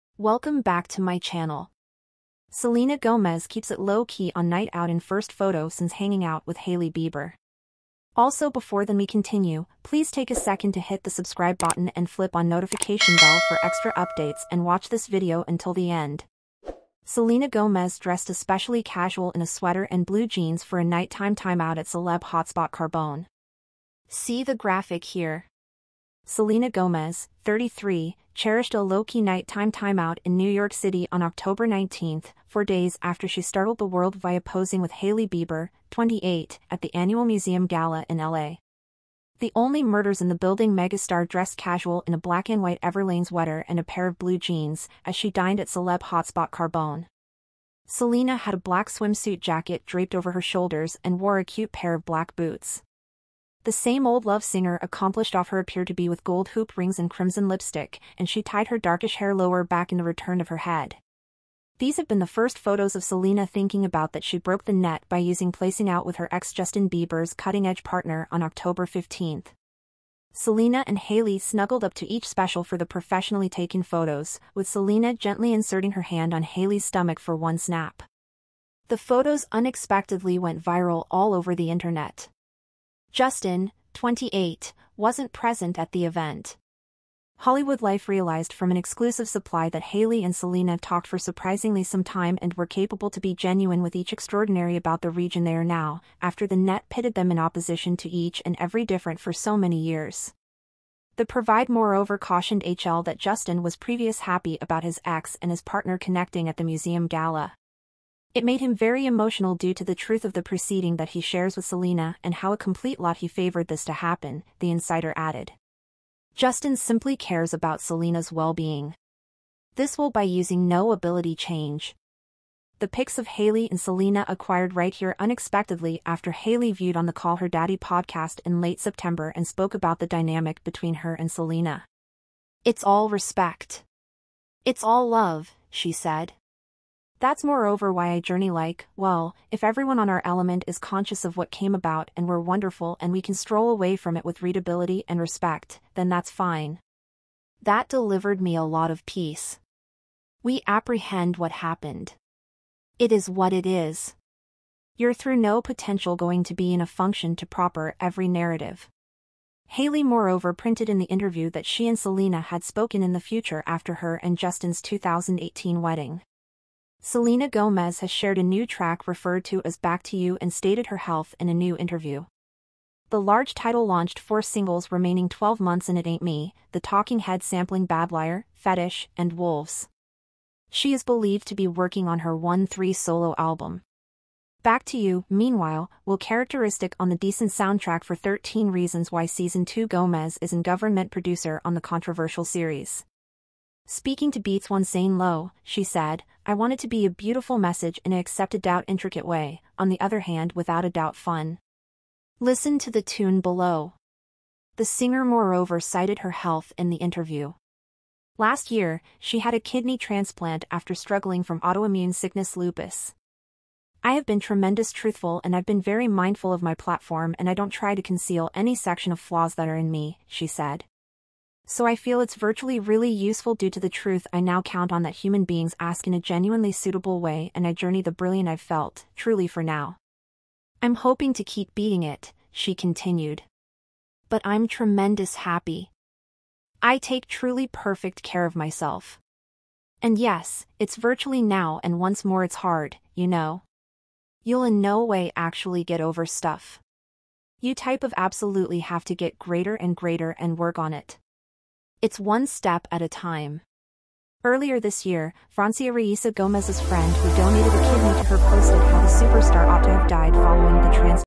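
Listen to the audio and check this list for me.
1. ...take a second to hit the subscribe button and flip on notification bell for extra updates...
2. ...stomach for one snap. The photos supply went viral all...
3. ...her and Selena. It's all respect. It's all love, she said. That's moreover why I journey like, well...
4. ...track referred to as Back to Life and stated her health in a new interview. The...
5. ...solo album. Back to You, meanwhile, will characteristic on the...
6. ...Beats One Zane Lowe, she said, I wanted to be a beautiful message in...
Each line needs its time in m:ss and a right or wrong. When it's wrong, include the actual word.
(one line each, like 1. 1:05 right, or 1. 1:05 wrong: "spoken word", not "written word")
1. 0:10 right
2. 1:16 wrong: "unexpectedly", not "supply"
3. 2:10 right
4. 2:48 wrong: "You", not "Life"
5. 3:02 right
6. 3:14 right.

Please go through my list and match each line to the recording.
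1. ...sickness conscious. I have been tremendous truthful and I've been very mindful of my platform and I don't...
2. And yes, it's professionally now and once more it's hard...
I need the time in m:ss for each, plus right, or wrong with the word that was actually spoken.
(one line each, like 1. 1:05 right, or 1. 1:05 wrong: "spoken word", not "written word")
1. 3:32 wrong: "lupus", not "conscious"
2. 4:00 wrong: "virtually", not "professionally".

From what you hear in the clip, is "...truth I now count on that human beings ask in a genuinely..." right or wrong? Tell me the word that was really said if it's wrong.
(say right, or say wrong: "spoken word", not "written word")
right.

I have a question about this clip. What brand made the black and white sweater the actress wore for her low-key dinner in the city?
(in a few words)
Everlane.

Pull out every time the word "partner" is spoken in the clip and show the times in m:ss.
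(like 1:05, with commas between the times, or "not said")
1:07, 1:45.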